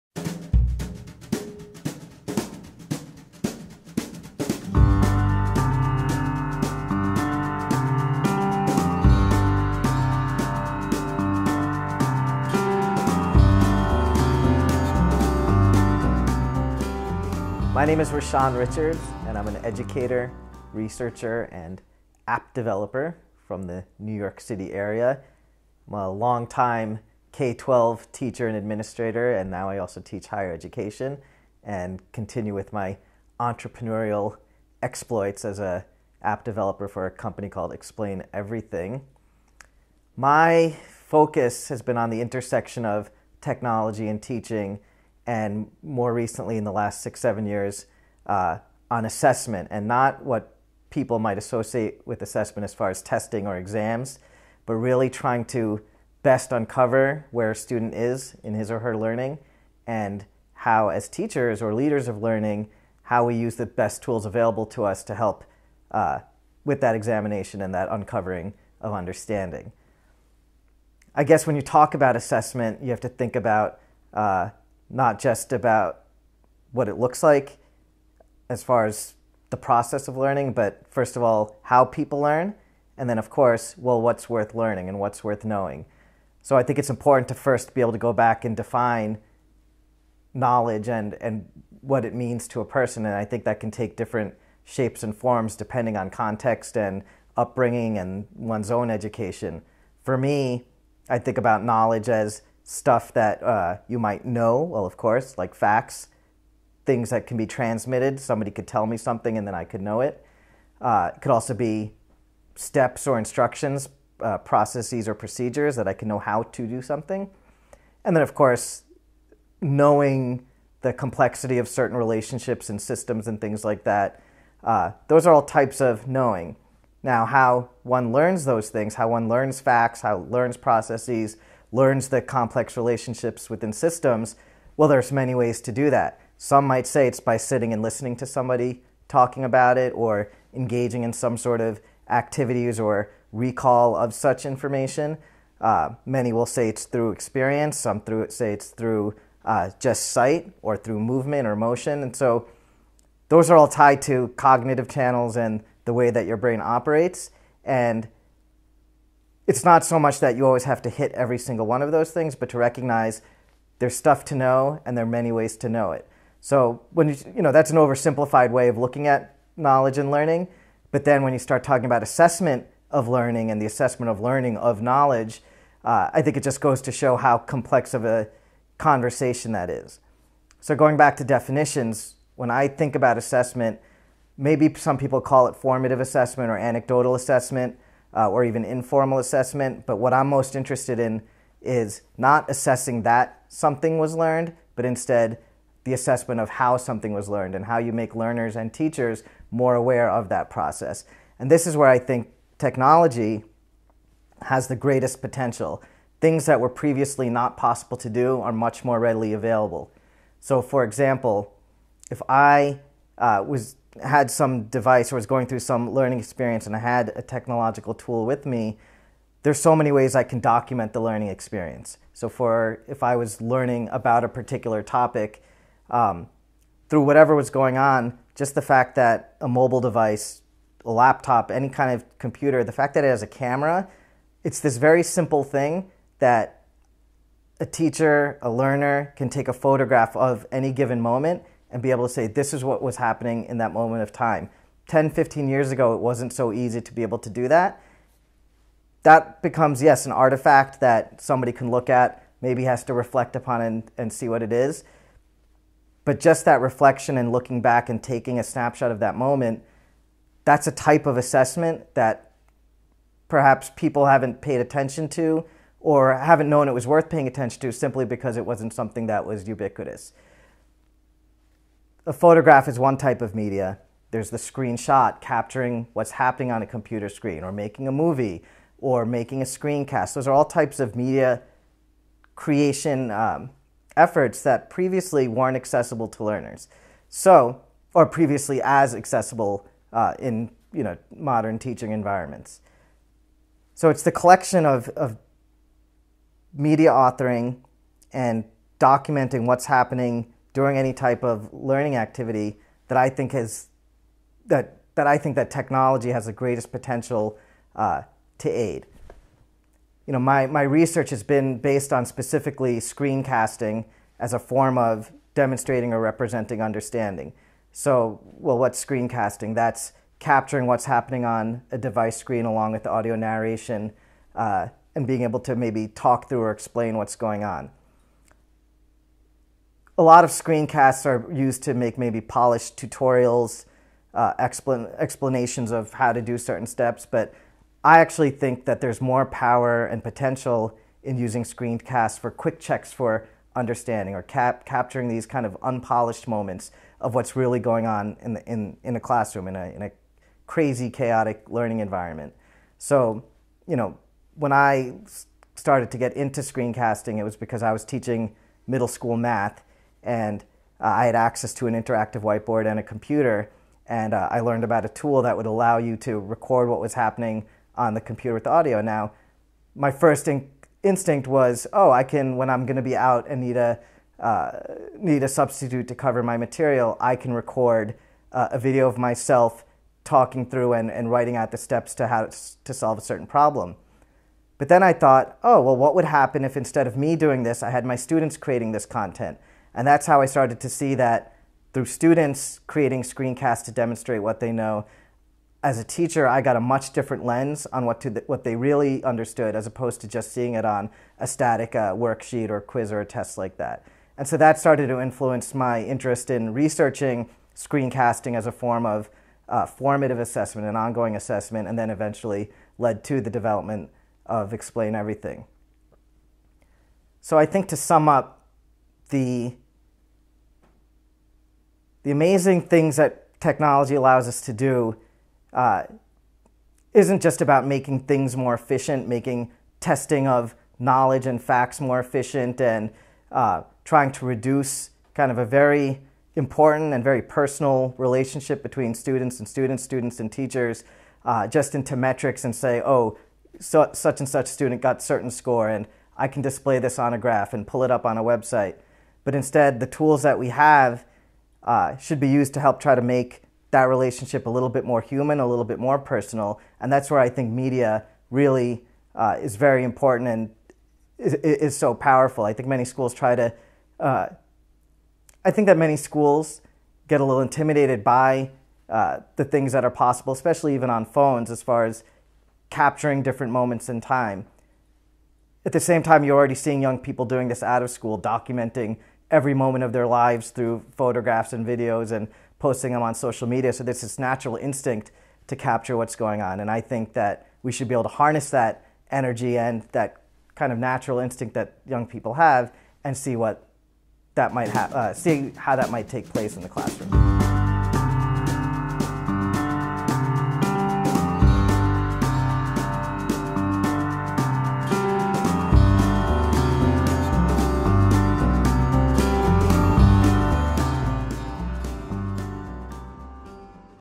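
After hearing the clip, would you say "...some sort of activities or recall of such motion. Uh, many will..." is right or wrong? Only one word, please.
wrong.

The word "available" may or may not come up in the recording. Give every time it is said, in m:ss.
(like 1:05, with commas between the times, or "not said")
1:04, 3:29.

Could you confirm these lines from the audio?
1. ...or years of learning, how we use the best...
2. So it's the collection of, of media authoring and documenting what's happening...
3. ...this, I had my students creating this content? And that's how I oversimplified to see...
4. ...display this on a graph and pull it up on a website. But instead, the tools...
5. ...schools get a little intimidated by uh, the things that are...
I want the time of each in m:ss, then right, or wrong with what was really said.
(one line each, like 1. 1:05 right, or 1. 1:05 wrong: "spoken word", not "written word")
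1. 1:01 wrong: "leaders", not "years"
2. 4:53 right
3. 6:27 wrong: "started", not "oversimplified"
4. 7:26 right
5. 7:45 right.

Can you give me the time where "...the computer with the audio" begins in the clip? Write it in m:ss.
6:07.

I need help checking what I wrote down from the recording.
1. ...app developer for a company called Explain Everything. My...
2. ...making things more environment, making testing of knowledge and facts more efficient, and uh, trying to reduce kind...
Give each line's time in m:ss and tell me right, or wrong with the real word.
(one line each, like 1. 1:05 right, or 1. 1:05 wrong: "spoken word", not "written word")
1. 0:36 right
2. 7:07 wrong: "efficient", not "environment".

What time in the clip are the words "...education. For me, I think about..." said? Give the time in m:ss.
1:38.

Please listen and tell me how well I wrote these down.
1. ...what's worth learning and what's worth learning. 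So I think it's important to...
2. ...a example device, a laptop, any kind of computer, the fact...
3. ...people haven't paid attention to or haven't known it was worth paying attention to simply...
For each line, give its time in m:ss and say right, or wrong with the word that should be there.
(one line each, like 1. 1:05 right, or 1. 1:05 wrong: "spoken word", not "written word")
1. 1:24 wrong: "knowing", not "learning"
2. 3:49 wrong: "mobile", not "example"
3. 4:23 right.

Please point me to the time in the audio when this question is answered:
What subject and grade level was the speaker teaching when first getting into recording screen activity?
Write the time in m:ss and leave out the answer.
5:58.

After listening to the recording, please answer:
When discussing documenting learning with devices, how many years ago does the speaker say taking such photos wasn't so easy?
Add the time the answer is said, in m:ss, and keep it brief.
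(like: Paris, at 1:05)
10, 15 years, at 4:04.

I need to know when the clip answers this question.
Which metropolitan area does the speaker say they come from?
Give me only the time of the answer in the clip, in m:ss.
0:23.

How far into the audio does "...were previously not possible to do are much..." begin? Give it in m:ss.
3:26.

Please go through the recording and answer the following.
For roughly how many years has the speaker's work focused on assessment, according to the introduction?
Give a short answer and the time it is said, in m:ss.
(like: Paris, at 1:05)
six, seven years, at 0:47.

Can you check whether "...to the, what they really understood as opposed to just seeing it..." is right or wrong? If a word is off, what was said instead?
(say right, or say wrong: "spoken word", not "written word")
right.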